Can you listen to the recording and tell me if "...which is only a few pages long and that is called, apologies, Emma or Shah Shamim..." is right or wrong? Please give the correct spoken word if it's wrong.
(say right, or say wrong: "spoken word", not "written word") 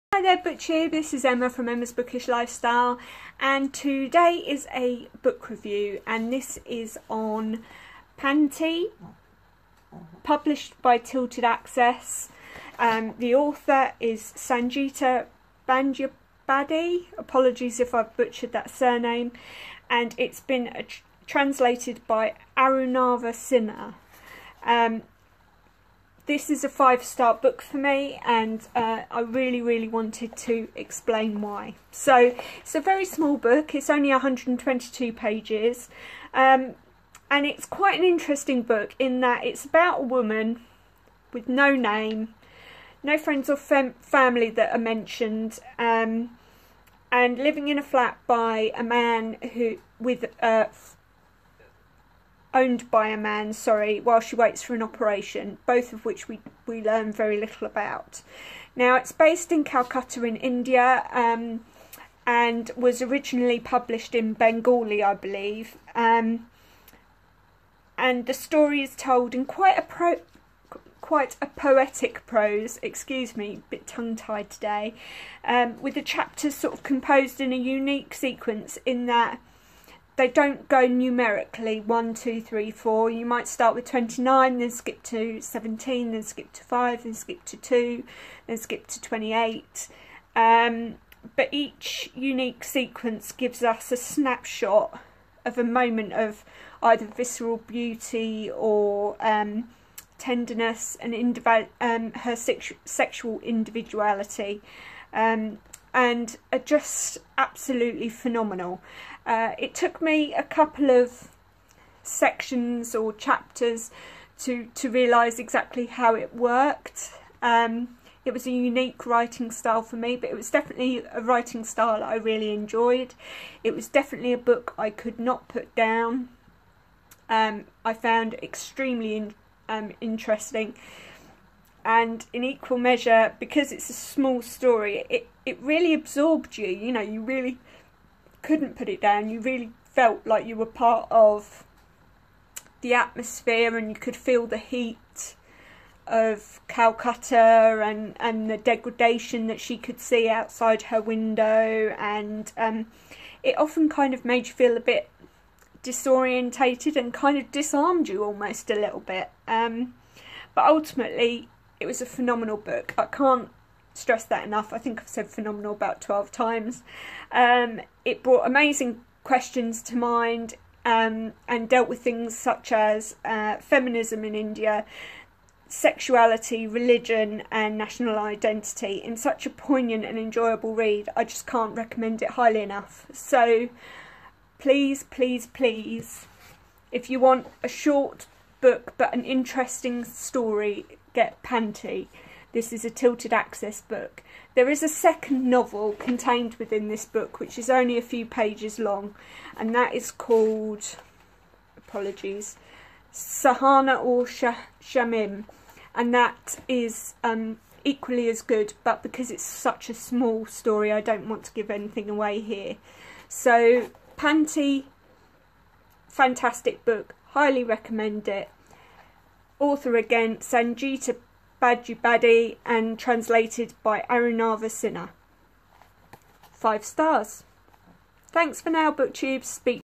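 wrong: "Sahana", not "Emma".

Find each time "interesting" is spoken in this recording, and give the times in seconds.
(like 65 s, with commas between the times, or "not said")
38 s, 130 s, 189 s.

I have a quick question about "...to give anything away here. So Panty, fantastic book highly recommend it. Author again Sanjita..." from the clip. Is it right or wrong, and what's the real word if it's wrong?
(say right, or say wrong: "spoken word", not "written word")
right.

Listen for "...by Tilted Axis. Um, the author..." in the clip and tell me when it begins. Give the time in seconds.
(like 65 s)
10 s.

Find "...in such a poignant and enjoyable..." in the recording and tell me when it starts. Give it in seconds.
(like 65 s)
179 s.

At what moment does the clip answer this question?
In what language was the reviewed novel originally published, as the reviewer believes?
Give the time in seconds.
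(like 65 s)
64 s.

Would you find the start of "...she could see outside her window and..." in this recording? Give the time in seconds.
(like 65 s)
149 s.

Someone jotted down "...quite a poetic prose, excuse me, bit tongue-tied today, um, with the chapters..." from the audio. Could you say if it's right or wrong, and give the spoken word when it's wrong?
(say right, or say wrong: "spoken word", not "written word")
right.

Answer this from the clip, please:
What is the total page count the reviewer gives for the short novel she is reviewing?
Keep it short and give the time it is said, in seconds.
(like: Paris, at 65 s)
122, at 34 s.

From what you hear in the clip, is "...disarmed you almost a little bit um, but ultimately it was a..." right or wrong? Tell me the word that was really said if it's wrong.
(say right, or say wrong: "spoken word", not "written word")
right.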